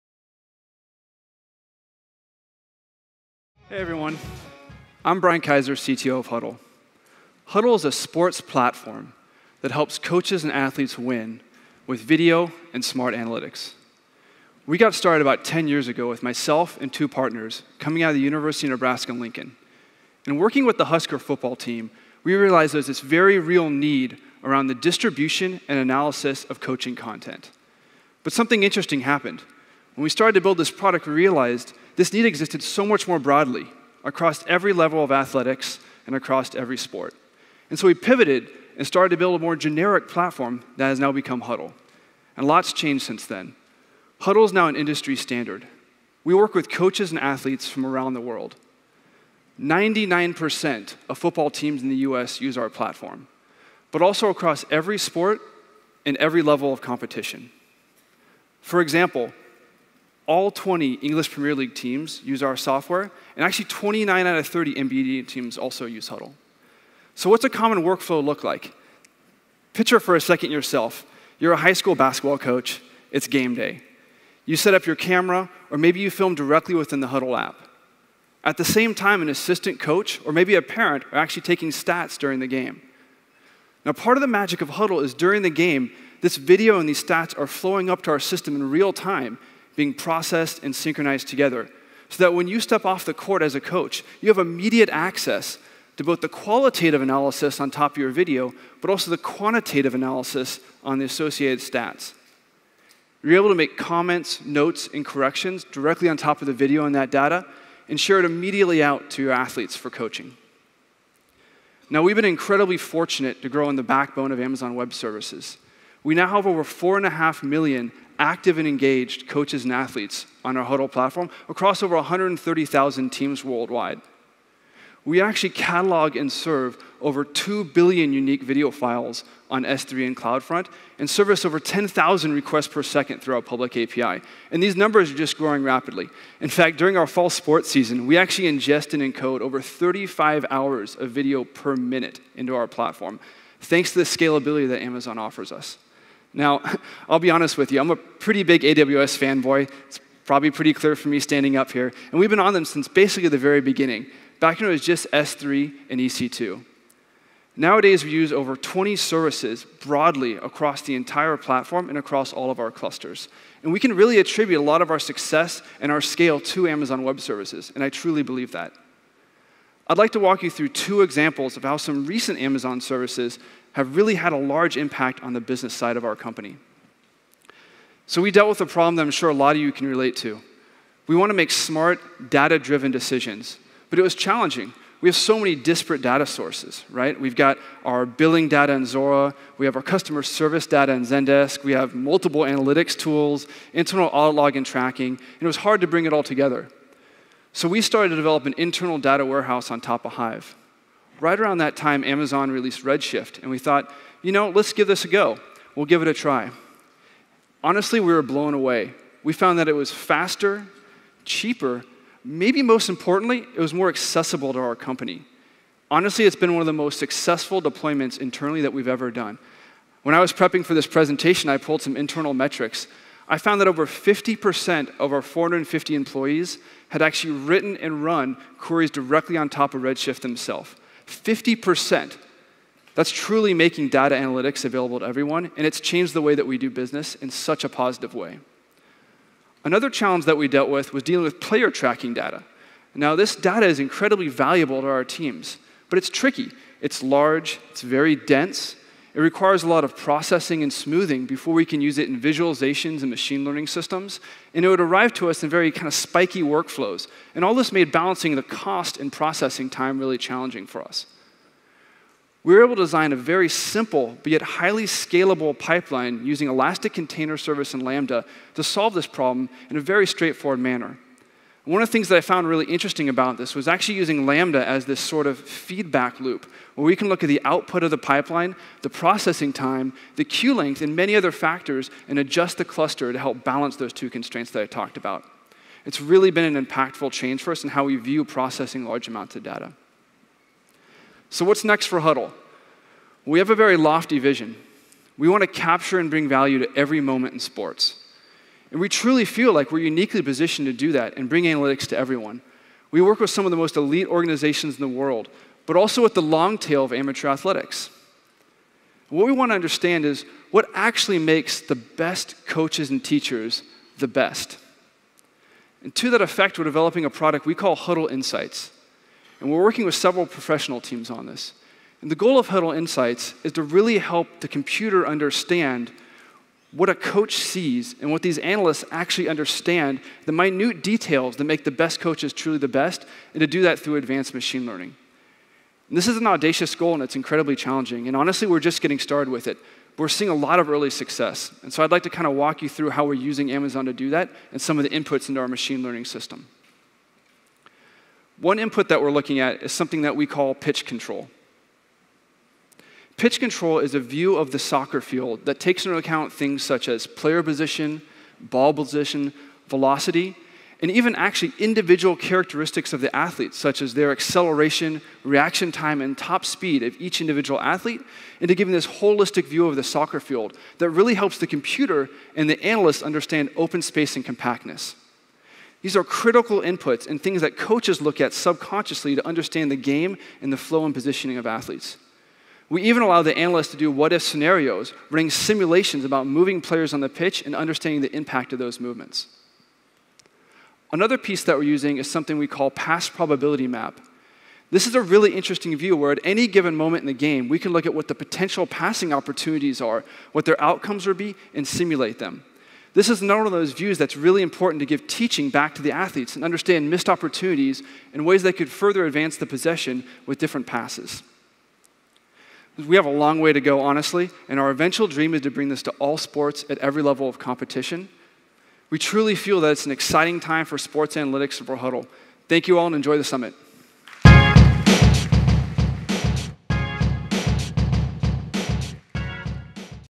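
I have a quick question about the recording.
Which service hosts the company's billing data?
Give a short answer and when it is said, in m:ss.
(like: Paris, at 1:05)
Zuora, at 3:08.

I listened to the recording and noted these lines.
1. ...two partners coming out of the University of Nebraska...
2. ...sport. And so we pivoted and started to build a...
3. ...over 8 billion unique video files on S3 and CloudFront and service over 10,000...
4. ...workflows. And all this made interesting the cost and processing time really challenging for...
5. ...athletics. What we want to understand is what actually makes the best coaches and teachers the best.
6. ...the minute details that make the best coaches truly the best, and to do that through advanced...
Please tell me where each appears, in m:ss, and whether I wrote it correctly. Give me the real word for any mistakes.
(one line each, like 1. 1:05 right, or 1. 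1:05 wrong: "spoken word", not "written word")
1. 0:16 right
2. 0:36 right
3. 2:07 wrong: "2", not "8"
4. 4:16 wrong: "balancing", not "interesting"
5. 5:07 right
6. 5:30 right.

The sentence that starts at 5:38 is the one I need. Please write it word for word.
And honestly, we're just getting started with it.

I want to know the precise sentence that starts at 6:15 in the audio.
These are critical inputs and things that coaches look at subconsciously to understand the game and the flow and positioning of athletes.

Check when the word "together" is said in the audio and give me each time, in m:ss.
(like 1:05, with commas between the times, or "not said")
1:31, 3:16.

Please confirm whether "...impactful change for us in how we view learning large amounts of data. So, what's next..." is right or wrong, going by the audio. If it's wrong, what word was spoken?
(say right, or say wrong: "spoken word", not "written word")
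wrong: "processing", not "learning".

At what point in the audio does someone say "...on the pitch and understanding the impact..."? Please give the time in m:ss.
6:26.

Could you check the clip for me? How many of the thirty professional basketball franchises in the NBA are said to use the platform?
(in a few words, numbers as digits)
29.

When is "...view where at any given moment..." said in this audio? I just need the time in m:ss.
6:35.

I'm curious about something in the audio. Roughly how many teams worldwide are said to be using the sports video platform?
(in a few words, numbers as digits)
130,000.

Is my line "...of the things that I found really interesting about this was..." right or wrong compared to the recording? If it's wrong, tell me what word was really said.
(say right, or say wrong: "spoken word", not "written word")
right.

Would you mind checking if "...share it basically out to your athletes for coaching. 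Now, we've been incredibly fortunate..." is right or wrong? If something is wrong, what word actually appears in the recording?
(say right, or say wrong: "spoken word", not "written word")
wrong: "immediately", not "basically".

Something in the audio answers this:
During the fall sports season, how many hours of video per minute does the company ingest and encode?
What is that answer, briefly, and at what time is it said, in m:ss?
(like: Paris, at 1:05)
35, at 2:19.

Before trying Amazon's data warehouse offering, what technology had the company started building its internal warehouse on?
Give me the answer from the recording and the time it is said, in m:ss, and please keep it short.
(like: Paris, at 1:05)
Hive, at 3:20.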